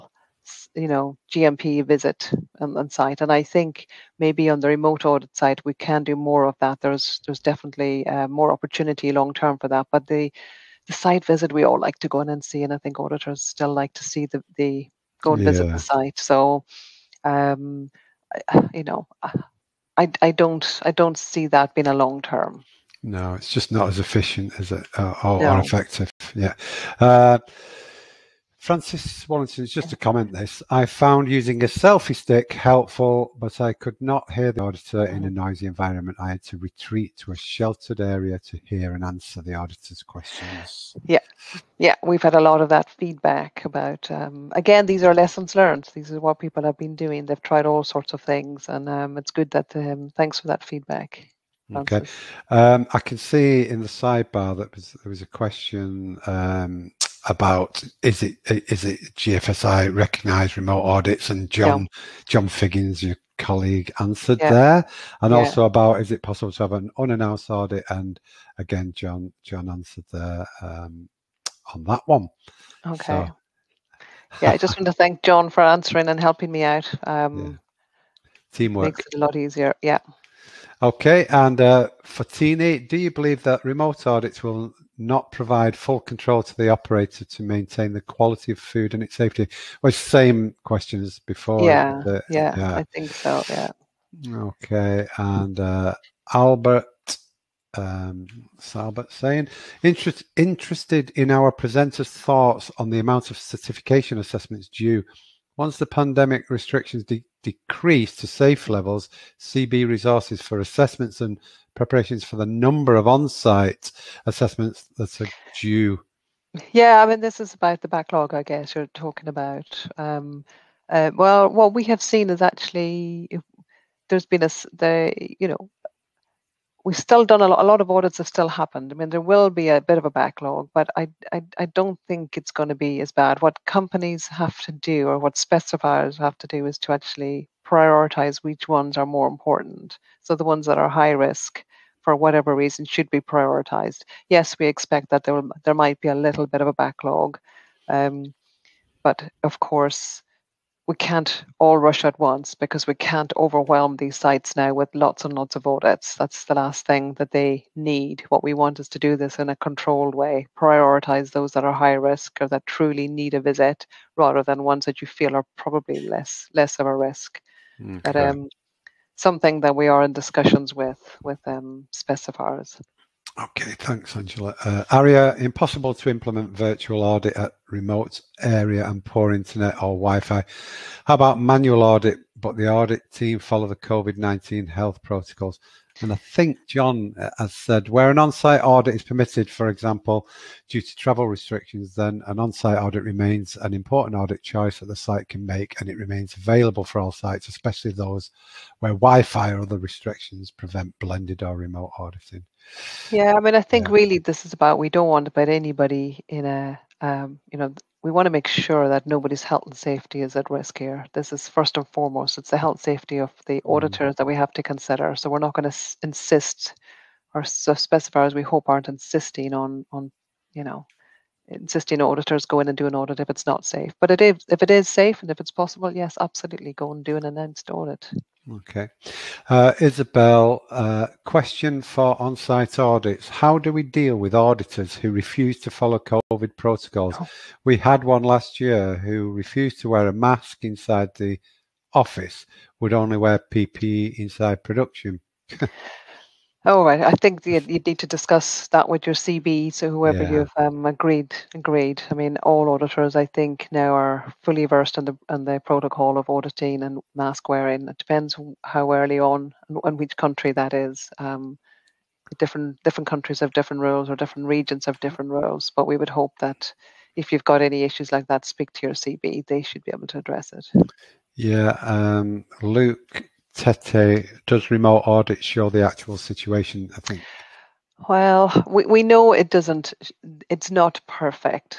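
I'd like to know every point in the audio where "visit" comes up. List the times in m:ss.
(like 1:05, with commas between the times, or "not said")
0:01, 0:11, 0:15, 2:43.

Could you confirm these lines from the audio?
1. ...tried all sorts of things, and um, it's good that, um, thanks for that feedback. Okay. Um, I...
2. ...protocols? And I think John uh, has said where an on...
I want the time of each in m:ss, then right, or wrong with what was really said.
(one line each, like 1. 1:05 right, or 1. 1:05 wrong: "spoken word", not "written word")
1. 0:47 right
2. 3:05 right.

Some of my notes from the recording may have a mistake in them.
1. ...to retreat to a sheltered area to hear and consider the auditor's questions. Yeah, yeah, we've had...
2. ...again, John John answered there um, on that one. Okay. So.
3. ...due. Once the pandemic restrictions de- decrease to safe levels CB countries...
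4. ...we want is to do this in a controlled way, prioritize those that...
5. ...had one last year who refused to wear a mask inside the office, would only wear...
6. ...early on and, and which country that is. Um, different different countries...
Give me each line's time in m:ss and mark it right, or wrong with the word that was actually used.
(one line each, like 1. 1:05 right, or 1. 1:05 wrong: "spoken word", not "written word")
1. 0:36 wrong: "answer", not "consider"
2. 1:08 right
3. 1:44 wrong: "resources", not "countries"
4. 2:38 right
5. 3:57 right
6. 4:18 right.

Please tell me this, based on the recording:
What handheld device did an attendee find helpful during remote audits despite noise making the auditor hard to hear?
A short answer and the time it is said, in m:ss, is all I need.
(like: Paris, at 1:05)
selfie stick, at 0:31.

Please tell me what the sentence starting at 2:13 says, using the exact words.
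What companies have to do or what specifiers have to do is to actually prioritize which ones are more important.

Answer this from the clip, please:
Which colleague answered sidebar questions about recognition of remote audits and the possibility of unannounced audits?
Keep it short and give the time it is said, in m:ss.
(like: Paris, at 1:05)
John Figgins, at 1:02.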